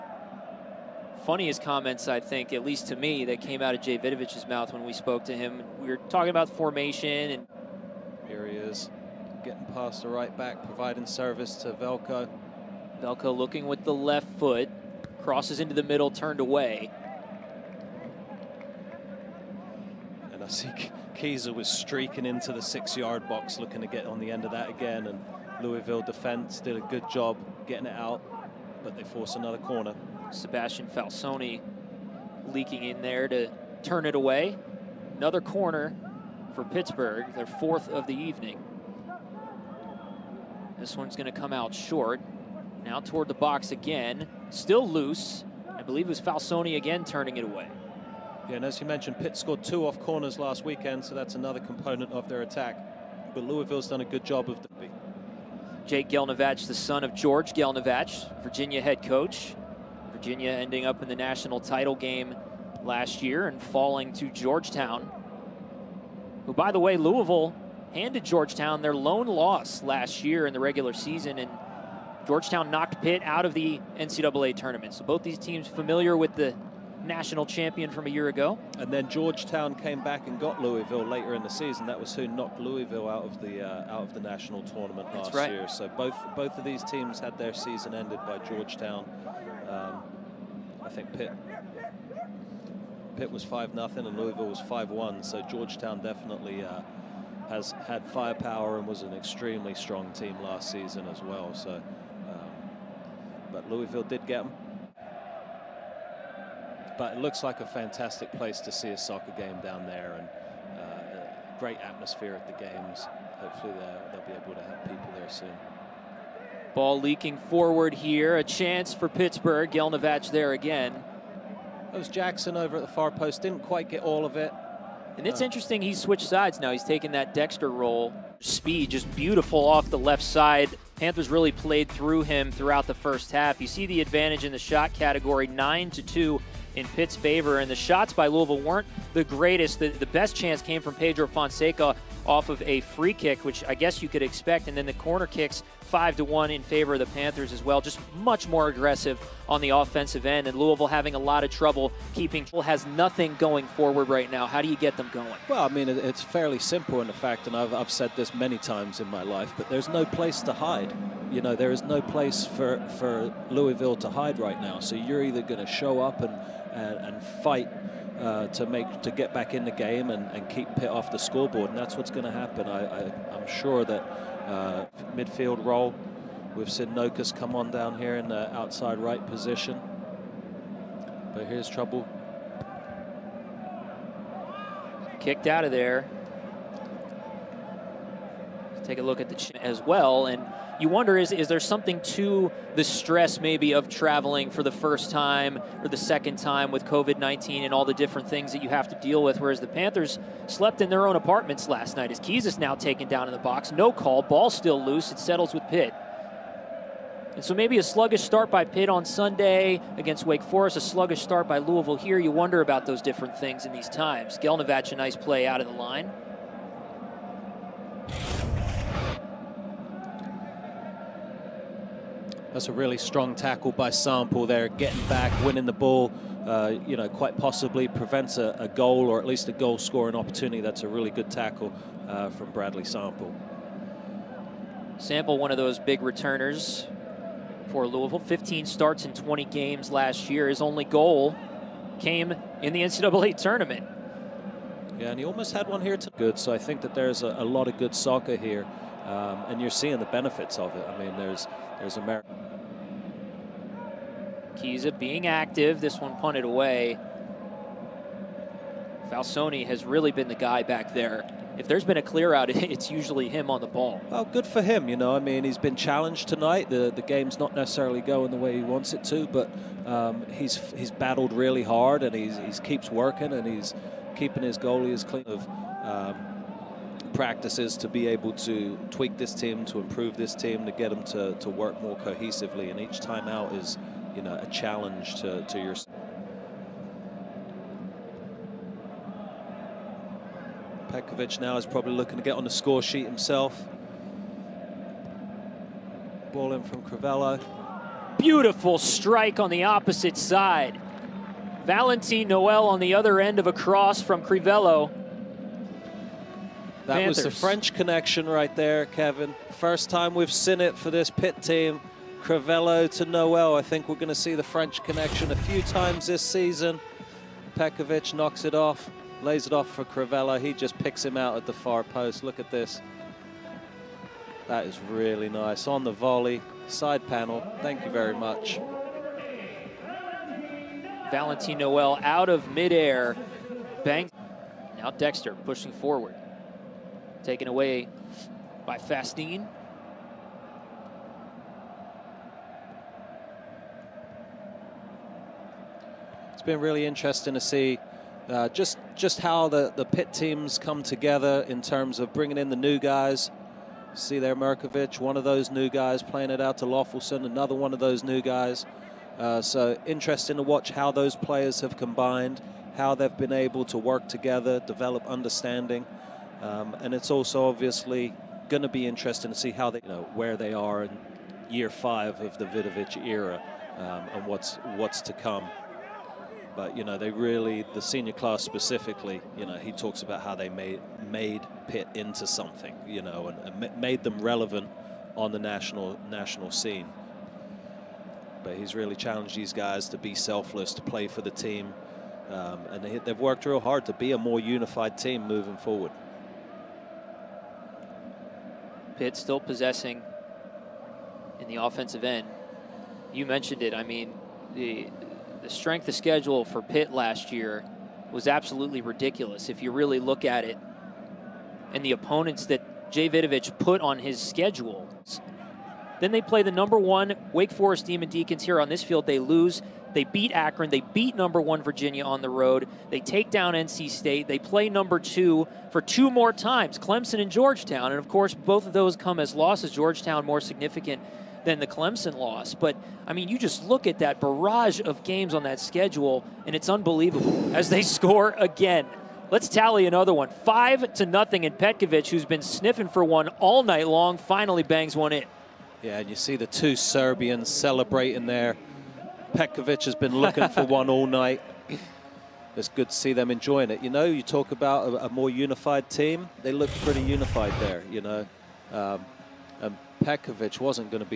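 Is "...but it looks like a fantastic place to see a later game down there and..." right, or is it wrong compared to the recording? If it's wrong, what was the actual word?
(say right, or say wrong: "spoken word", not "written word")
wrong: "soccer", not "later".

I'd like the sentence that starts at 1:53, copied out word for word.
Hopefully they'll be able to have people there soon.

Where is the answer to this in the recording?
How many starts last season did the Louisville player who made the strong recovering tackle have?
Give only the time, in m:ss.
3:58.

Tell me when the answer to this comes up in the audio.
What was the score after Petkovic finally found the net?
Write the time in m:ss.
7:20.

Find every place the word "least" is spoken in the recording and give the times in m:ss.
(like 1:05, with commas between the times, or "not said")
0:02, 3:49.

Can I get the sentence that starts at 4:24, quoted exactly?
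Well, good for him, you know.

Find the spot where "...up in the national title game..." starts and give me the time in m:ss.
1:00.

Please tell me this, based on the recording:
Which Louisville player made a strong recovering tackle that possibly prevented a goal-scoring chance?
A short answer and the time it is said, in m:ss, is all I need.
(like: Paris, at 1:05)
Bradley Sample, at 3:52.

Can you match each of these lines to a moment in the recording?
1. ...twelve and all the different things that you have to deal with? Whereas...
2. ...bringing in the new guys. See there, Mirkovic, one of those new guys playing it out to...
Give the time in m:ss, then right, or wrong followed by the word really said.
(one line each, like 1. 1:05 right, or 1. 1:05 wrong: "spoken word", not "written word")
1. 3:17 wrong: "nineteen", not "twelve"
2. 5:52 right.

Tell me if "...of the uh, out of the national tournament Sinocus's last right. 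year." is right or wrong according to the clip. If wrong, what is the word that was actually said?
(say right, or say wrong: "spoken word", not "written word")
wrong: "That", not "Sinocus".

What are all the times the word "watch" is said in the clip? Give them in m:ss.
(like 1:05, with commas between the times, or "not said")
6:00.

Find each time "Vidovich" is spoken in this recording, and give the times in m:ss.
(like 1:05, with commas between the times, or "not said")
0:03, 6:12, 6:53.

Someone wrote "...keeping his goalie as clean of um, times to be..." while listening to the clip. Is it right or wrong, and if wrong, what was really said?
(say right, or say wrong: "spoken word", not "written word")
wrong: "practices", not "times".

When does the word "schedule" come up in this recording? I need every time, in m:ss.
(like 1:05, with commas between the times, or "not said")
6:45, 6:54, 7:15.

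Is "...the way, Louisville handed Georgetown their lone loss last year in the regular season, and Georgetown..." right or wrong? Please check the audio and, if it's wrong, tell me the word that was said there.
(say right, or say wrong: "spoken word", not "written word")
right.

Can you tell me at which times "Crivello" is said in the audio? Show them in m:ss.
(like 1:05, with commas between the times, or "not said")
4:56, 5:04, 5:12, 5:19.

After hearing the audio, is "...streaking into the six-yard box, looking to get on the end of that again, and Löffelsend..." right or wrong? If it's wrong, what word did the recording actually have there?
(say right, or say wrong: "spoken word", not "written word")
wrong: "Louisville", not "Löffelsend".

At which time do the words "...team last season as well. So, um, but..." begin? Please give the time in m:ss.
1:40.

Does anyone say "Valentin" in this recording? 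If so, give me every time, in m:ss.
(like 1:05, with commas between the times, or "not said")
5:01, 5:31.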